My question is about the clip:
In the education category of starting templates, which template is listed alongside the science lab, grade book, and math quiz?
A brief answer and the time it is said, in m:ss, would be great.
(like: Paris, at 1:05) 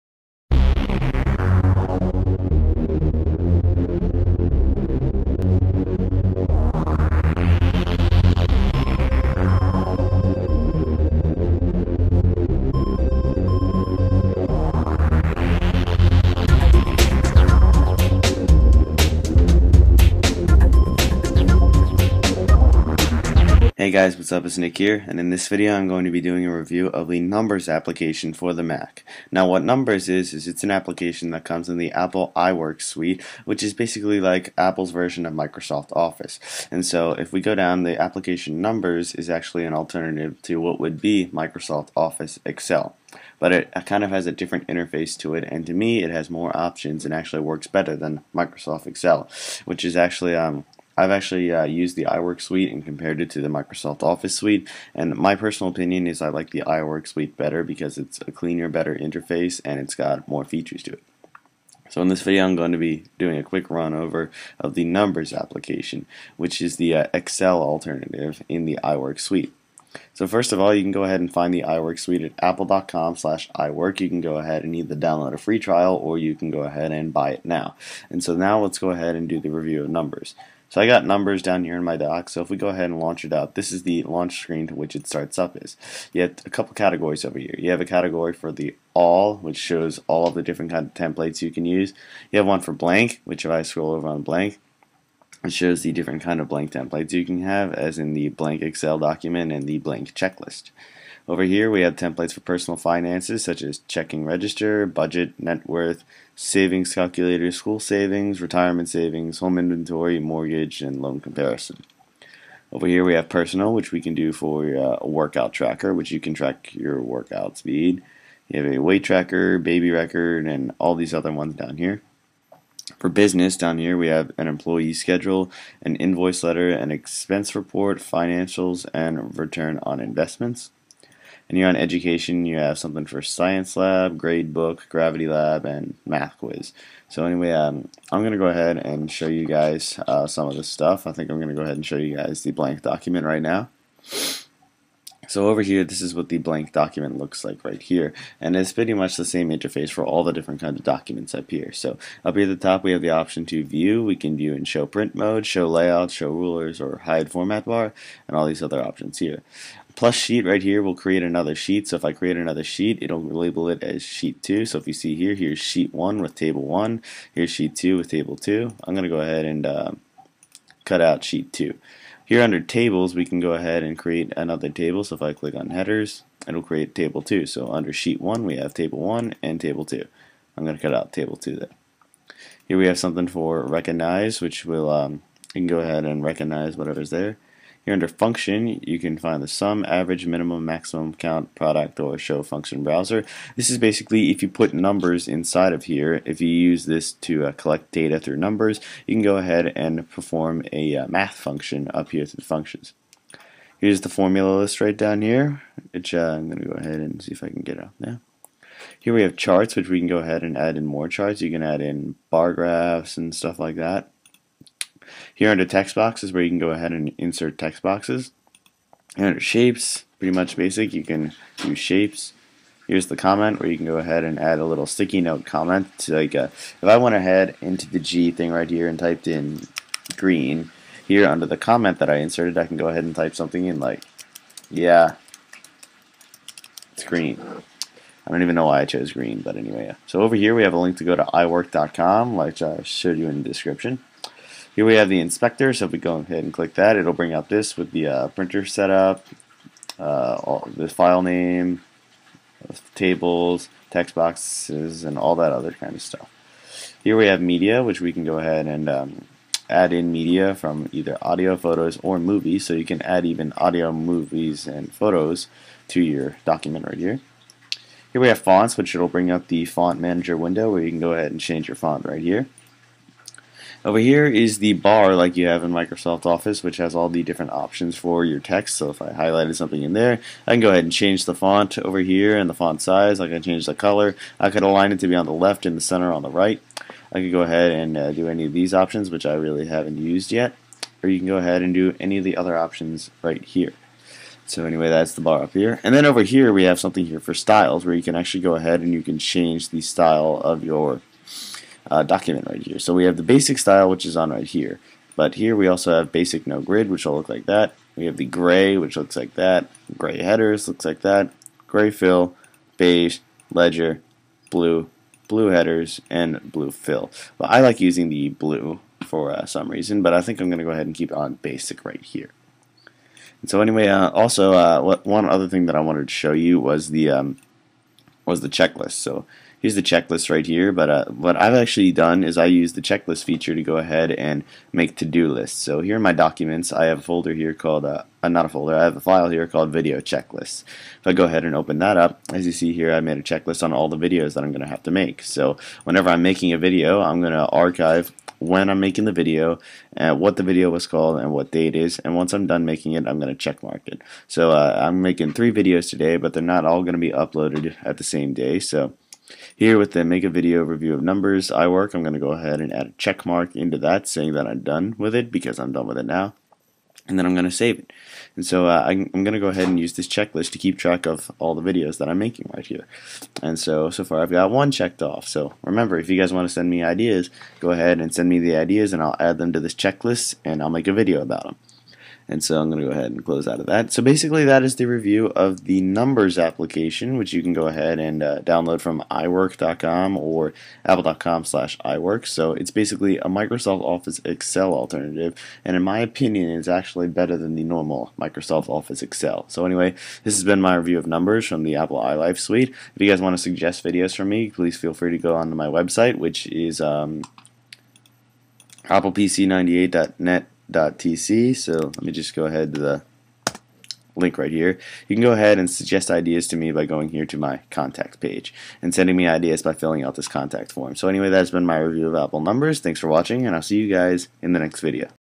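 gravity lab, at 2:14.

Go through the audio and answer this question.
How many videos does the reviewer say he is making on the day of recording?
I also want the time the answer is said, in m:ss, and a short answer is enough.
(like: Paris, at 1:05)
3, at 5:55.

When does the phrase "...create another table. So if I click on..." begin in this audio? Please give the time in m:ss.
2:53.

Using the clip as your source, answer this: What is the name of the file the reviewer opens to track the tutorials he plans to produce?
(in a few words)
video checklist.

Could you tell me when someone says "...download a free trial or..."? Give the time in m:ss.
1:14.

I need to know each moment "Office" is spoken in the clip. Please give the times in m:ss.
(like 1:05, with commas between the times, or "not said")
0:35, 0:41, 0:54, 4:36, 6:33, 6:38.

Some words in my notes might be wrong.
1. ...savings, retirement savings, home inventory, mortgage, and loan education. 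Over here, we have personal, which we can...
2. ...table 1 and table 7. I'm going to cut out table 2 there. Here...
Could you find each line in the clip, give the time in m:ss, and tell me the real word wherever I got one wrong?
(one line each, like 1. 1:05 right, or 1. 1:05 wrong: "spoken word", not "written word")
1. 1:47 wrong: "comparison", not "education"
2. 2:58 wrong: "2", not "7".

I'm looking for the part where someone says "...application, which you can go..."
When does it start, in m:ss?
6:26.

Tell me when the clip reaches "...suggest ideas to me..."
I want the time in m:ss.
6:55.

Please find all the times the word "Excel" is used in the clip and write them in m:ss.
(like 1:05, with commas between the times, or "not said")
0:42, 0:48, 1:07, 1:38, 6:34, 6:39.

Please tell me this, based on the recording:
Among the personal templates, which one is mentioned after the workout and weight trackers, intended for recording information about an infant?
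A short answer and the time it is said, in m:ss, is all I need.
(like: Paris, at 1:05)
baby record, at 1:59.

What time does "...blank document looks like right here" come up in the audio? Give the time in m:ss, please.
2:26.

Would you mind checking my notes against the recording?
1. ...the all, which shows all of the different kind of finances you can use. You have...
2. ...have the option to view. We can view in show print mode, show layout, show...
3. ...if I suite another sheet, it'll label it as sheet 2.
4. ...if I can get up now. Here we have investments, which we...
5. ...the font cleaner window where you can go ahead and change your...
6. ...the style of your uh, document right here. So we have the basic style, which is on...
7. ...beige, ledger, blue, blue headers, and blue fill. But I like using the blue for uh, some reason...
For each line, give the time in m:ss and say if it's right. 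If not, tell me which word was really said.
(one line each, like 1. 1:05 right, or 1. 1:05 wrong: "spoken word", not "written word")
1. 1:28 wrong: "templates", not "finances"
2. 2:32 right
3. 2:41 wrong: "create", not "suite"
4. 3:27 wrong: "charts", not "investments"
5. 4:29 wrong: "manager", not "cleaner"
6. 4:59 right
7. 5:12 right.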